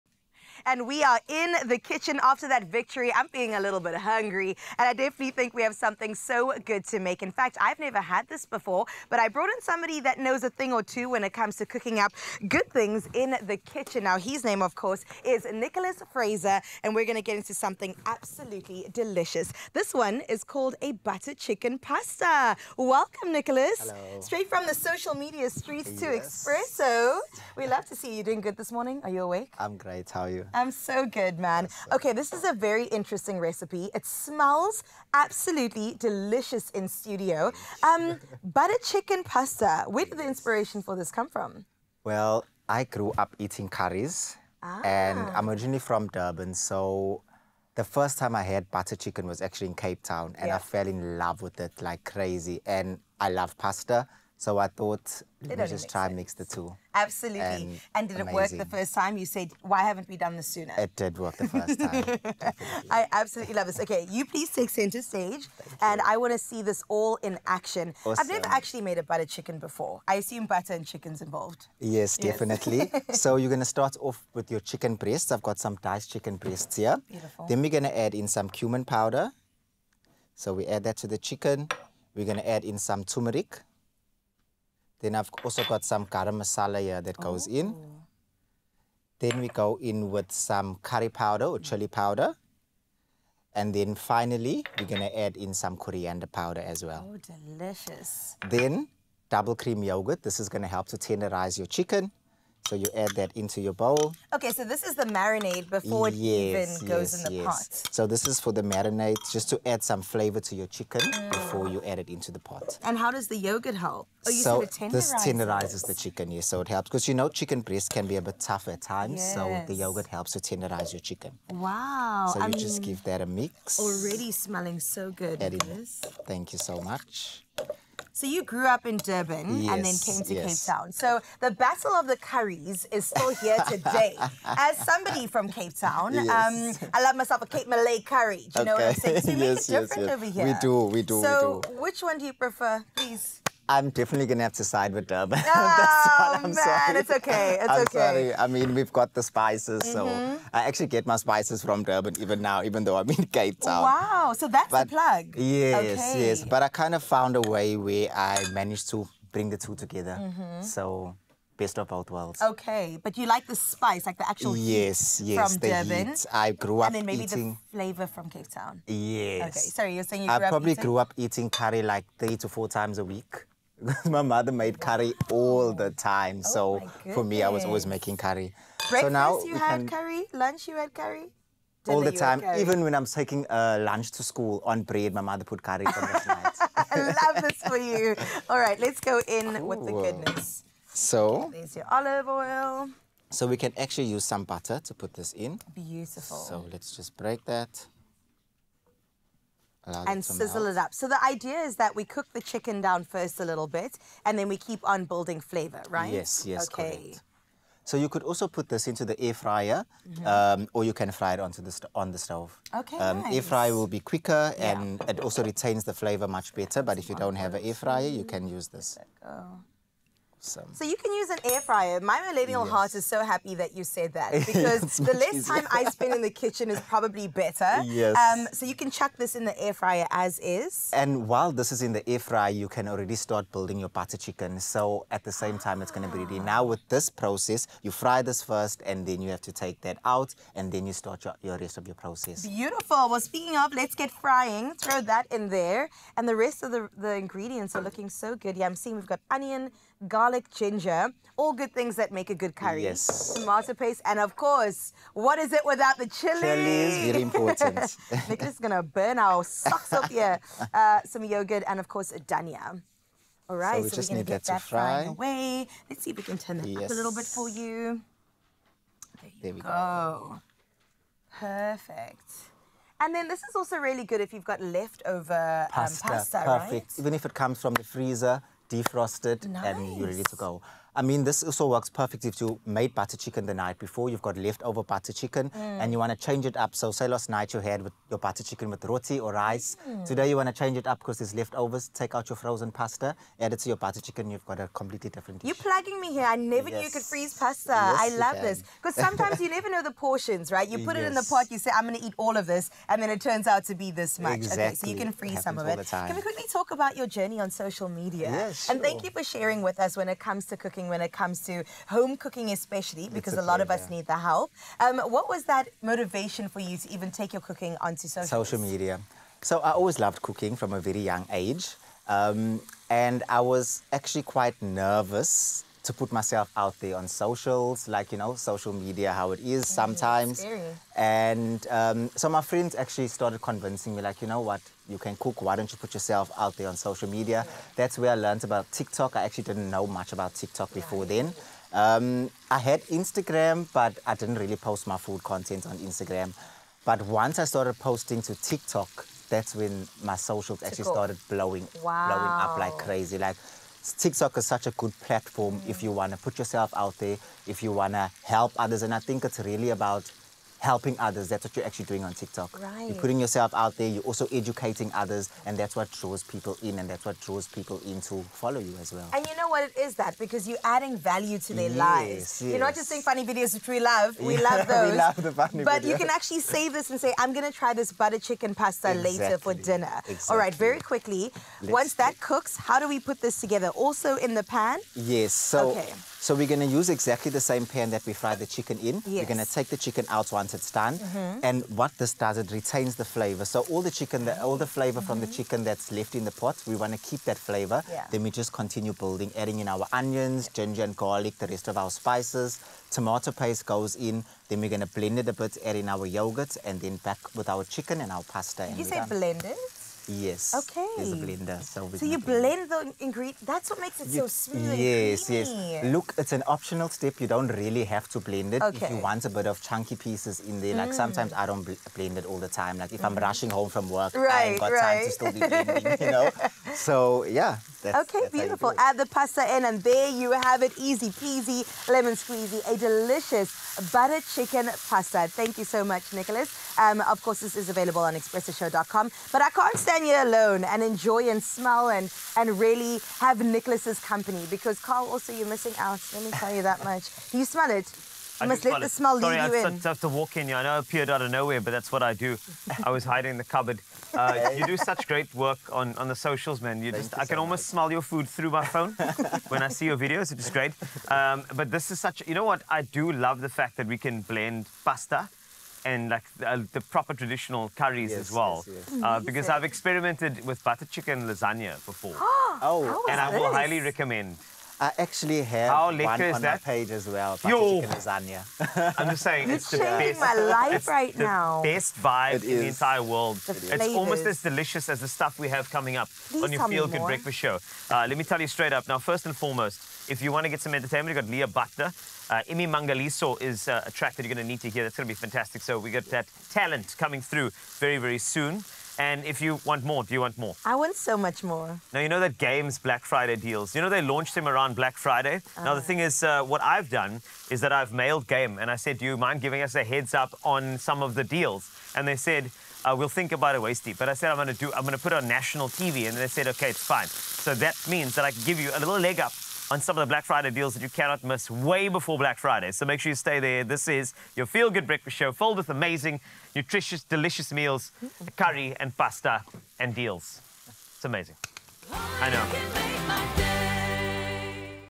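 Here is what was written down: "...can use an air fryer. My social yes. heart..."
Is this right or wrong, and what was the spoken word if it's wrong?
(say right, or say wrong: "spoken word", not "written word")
wrong: "millennial", not "social".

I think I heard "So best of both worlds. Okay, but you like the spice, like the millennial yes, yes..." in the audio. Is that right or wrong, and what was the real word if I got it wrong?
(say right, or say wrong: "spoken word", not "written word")
wrong: "actual", not "millennial".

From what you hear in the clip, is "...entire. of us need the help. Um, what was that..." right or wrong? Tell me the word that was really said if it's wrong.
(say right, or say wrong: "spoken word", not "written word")
wrong: "pleasure", not "entire".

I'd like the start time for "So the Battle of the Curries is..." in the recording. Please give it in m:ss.
2:10.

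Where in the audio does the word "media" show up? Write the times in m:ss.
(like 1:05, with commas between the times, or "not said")
0:25, 5:07, 5:18, 5:28, 5:37.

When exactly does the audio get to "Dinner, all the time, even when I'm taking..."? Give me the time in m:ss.
3:01.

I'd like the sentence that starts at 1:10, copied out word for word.
I assume butter and chicken's involved.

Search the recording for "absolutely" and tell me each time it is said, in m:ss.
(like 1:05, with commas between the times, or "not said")
0:18, 0:35, 0:56, 1:03.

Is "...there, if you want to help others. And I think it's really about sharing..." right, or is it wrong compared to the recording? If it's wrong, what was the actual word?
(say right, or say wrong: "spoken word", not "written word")
wrong: "helping", not "sharing".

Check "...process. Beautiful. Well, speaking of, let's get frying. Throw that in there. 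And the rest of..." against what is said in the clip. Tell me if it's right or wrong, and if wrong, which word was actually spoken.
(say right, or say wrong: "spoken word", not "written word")
right.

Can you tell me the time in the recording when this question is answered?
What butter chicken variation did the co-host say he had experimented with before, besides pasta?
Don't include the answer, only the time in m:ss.
7:50.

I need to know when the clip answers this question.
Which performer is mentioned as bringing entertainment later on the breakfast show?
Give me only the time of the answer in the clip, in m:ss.
8:11.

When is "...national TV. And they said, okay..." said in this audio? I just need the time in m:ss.
8:35.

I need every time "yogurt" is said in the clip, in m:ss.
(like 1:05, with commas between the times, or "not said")
1:39, 1:53, 1:59, 4:21, 6:46.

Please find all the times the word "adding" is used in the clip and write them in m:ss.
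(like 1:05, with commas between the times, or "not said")
6:10, 6:39.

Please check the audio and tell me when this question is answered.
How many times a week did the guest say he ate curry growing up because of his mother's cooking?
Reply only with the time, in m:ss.
2:52.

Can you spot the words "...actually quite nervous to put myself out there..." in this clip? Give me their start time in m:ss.
5:23.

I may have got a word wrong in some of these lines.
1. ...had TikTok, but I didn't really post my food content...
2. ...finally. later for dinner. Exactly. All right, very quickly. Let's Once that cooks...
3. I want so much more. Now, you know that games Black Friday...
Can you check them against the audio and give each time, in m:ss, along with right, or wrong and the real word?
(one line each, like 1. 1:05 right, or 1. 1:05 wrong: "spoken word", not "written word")
1. 5:42 wrong: "Instagram", not "TikTok"
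2. 6:18 wrong: "exactly", not "finally"
3. 8:20 right.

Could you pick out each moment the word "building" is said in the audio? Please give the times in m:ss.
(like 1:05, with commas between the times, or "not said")
3:25, 3:53, 6:38.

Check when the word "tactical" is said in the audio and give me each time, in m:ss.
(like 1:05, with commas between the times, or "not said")
not said.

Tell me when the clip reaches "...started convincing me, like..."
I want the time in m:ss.
5:33.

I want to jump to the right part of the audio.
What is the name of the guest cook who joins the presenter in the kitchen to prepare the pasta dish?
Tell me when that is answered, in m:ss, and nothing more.
0:15.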